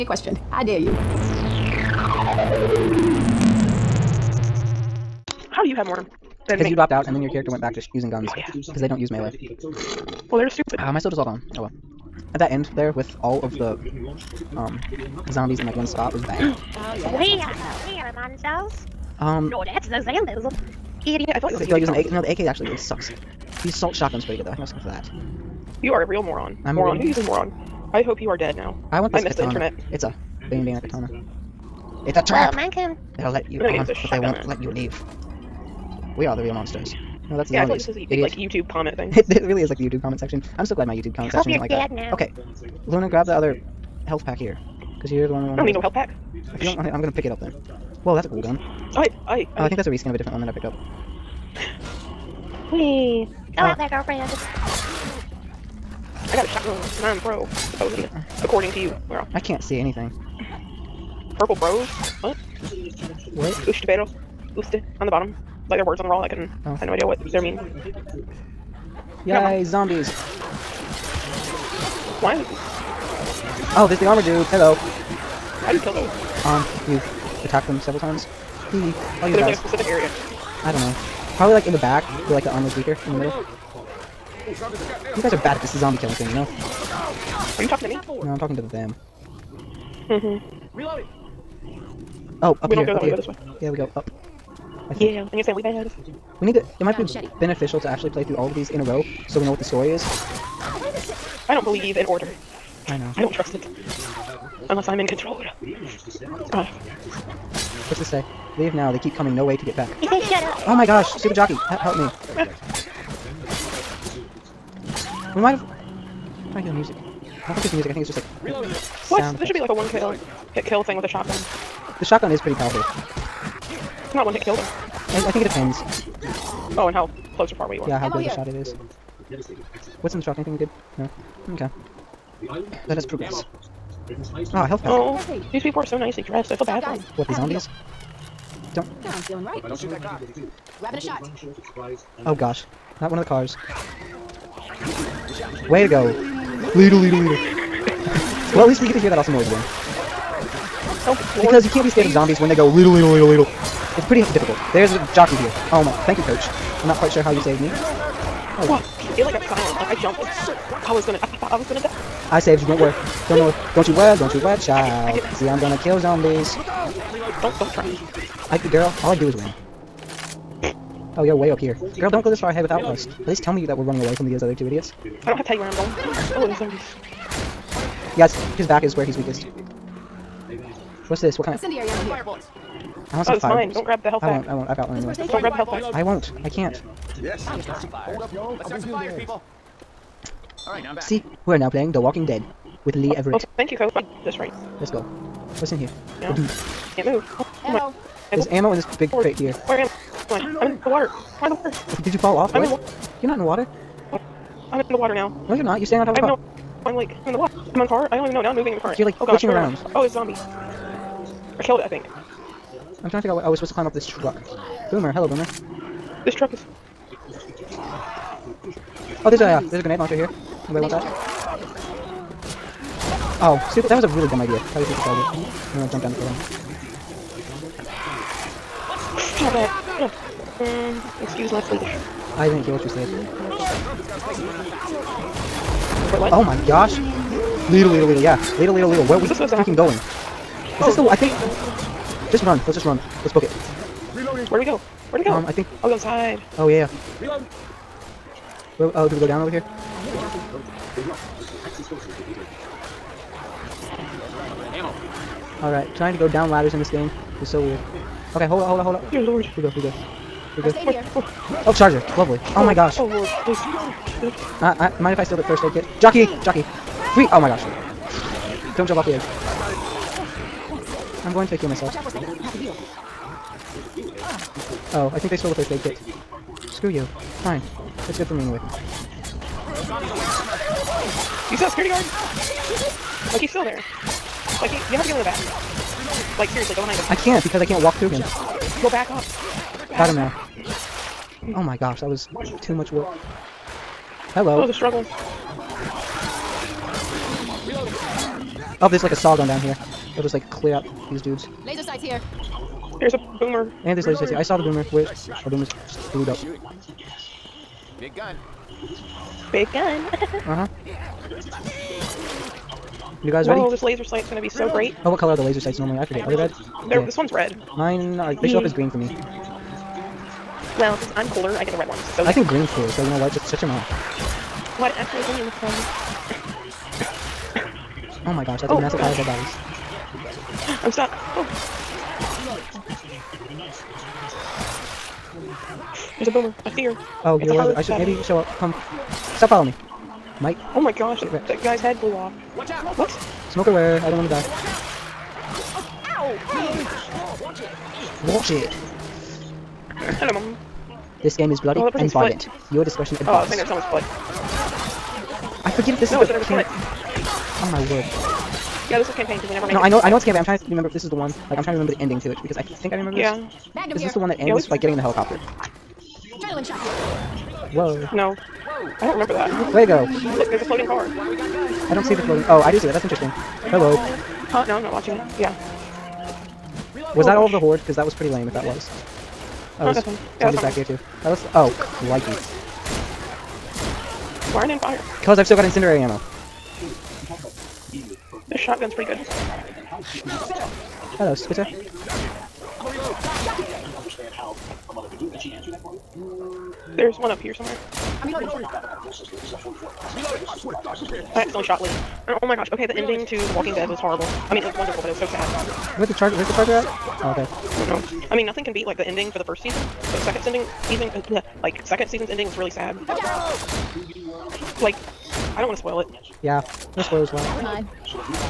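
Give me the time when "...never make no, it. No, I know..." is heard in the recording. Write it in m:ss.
5:59.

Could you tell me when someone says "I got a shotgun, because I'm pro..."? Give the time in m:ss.
0:56.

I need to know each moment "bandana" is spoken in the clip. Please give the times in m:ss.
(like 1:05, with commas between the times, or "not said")
0:30.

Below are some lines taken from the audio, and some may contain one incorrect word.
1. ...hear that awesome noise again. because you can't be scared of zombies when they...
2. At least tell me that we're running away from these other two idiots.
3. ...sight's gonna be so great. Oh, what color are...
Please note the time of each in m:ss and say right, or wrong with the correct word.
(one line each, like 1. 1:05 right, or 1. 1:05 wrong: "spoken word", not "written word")
1. 2:28 right
2. 2:53 right
3. 5:14 right.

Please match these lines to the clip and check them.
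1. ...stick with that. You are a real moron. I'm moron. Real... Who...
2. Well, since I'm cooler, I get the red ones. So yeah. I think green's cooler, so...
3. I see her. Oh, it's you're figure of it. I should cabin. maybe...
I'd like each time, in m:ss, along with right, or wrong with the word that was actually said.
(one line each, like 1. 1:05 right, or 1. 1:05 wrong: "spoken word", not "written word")
1. 0:24 right
2. 5:20 right
3. 5:36 wrong: "aware", not "figure".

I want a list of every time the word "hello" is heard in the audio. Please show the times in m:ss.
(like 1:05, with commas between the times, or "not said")
1:14, 3:35, 4:54, 5:50, 6:13, 6:31.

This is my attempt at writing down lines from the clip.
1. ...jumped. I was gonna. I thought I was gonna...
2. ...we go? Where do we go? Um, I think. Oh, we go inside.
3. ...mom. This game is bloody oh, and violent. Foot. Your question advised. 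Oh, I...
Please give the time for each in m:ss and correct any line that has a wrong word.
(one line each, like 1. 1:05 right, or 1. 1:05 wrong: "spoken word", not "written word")
1. 2:40 right
2. 4:04 right
3. 5:50 wrong: "discretion", not "question".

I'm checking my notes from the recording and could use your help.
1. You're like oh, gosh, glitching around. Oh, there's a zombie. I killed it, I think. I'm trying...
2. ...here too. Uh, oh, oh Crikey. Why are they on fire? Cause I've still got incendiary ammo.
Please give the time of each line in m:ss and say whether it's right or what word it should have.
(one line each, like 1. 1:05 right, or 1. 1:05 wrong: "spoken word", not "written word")
1. 3:28 right
2. 6:20 right.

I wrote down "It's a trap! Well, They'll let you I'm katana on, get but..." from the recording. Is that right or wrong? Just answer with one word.
wrong.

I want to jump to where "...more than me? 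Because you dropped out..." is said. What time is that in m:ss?
0:05.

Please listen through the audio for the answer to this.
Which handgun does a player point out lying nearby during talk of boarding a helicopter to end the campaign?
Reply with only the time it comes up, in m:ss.
6:03.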